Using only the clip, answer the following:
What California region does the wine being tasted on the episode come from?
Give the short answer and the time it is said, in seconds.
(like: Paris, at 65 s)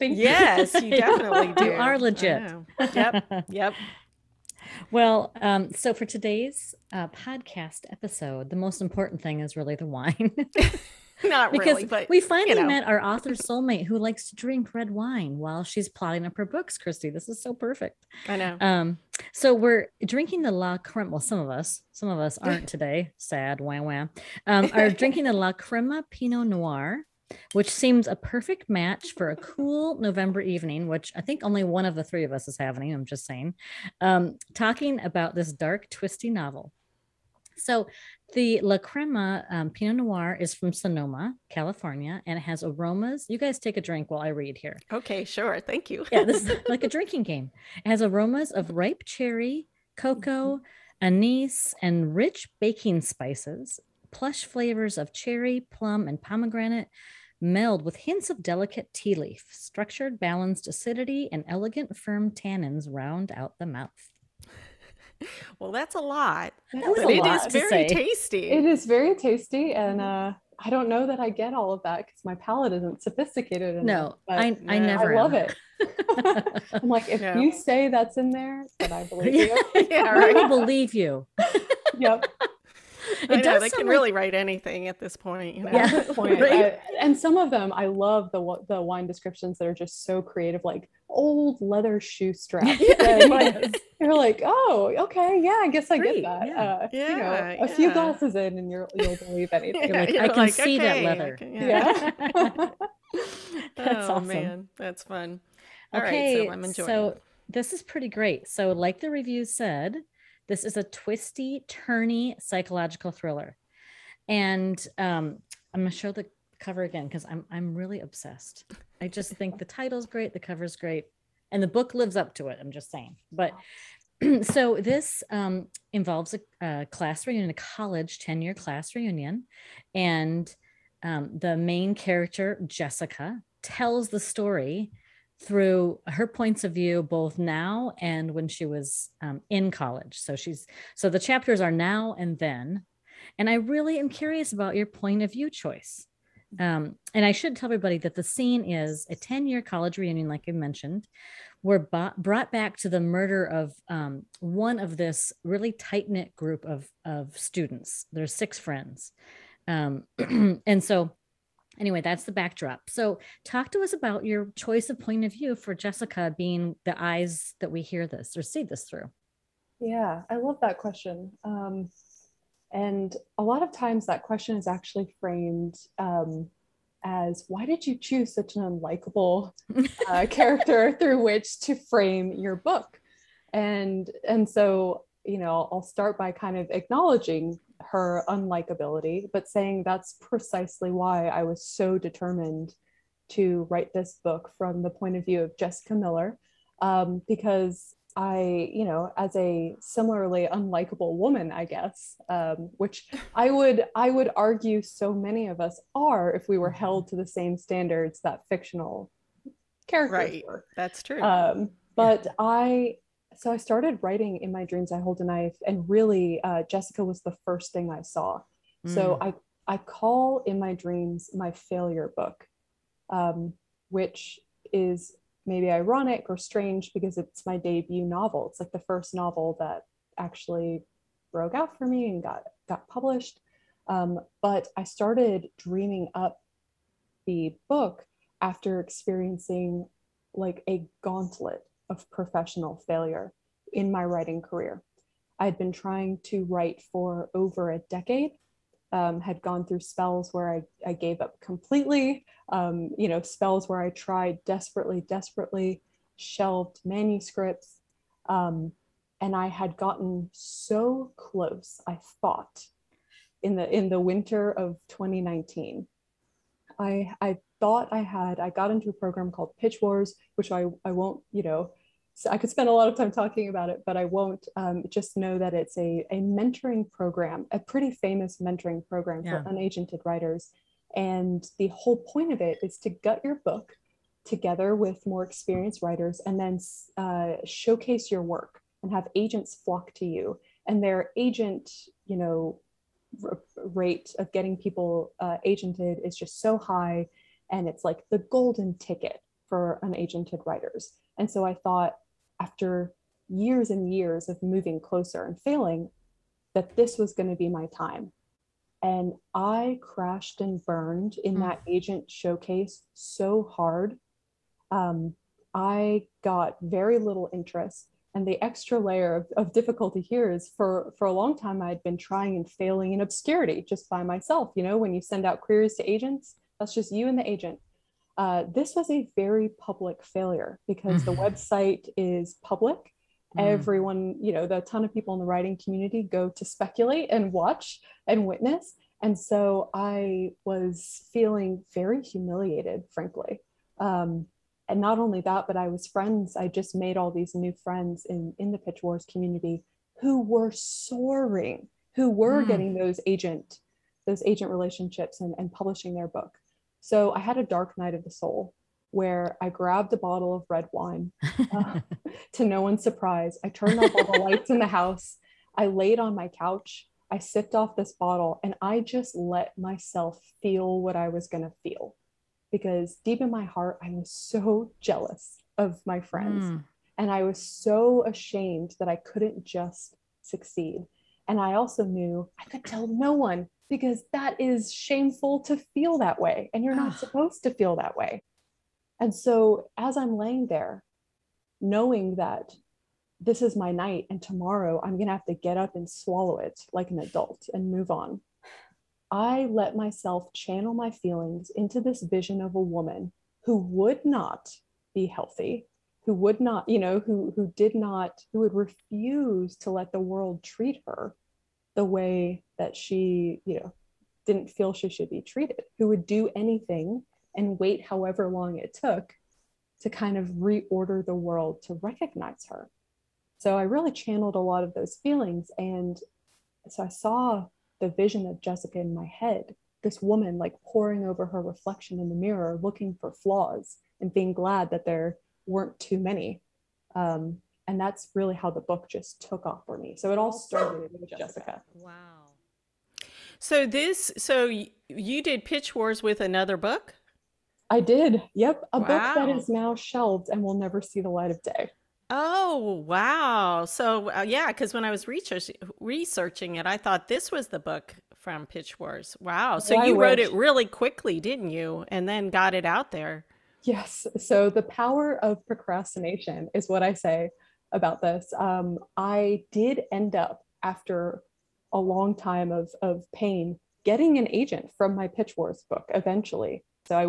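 Sonoma, at 40 s.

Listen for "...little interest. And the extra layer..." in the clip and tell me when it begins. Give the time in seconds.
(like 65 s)
316 s.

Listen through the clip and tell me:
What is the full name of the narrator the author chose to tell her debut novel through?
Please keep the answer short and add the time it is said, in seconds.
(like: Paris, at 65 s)
Jessica Miller, at 195 s.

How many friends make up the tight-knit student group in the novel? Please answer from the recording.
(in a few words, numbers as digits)
6.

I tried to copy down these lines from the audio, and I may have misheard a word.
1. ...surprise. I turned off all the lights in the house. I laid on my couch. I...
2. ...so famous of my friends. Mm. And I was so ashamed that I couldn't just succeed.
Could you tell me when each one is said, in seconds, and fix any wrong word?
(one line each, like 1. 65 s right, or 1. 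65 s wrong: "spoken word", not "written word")
1. 362 s right
2. 374 s wrong: "jealous", not "famous".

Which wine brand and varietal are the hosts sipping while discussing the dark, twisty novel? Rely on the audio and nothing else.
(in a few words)
La Crema Pinot Noir.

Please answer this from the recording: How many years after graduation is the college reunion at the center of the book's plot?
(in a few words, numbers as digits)
10.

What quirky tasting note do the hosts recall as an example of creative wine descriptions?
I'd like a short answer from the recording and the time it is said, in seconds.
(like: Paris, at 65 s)
old leather shoe strap, at 91 s.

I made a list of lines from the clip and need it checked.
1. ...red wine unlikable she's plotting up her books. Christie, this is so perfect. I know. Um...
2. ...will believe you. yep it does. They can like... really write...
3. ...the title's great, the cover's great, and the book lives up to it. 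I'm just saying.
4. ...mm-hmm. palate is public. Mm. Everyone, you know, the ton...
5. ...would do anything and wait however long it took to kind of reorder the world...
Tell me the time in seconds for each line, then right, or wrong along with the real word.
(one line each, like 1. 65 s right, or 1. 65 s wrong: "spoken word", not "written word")
1. 14 s wrong: "while", not "unlikable"
2. 80 s right
3. 119 s right
4. 331 s wrong: "website", not "palate"
5. 415 s right.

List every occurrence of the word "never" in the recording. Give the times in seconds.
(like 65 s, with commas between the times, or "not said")
74 s, 450 s.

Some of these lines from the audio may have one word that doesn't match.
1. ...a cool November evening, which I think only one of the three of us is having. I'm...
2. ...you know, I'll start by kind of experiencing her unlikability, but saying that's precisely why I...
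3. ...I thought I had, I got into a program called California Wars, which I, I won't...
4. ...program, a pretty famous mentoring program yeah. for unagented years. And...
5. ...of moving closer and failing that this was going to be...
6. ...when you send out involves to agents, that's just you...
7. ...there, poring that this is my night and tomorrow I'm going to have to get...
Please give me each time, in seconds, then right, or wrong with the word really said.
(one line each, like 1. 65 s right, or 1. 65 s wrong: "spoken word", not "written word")
1. 29 s right
2. 185 s wrong: "acknowledging", not "experiencing"
3. 267 s wrong: "Pitch", not "California"
4. 276 s wrong: "writers", not "years"
5. 304 s right
6. 324 s wrong: "queries", not "involves"
7. 390 s wrong: "knowing", not "poring".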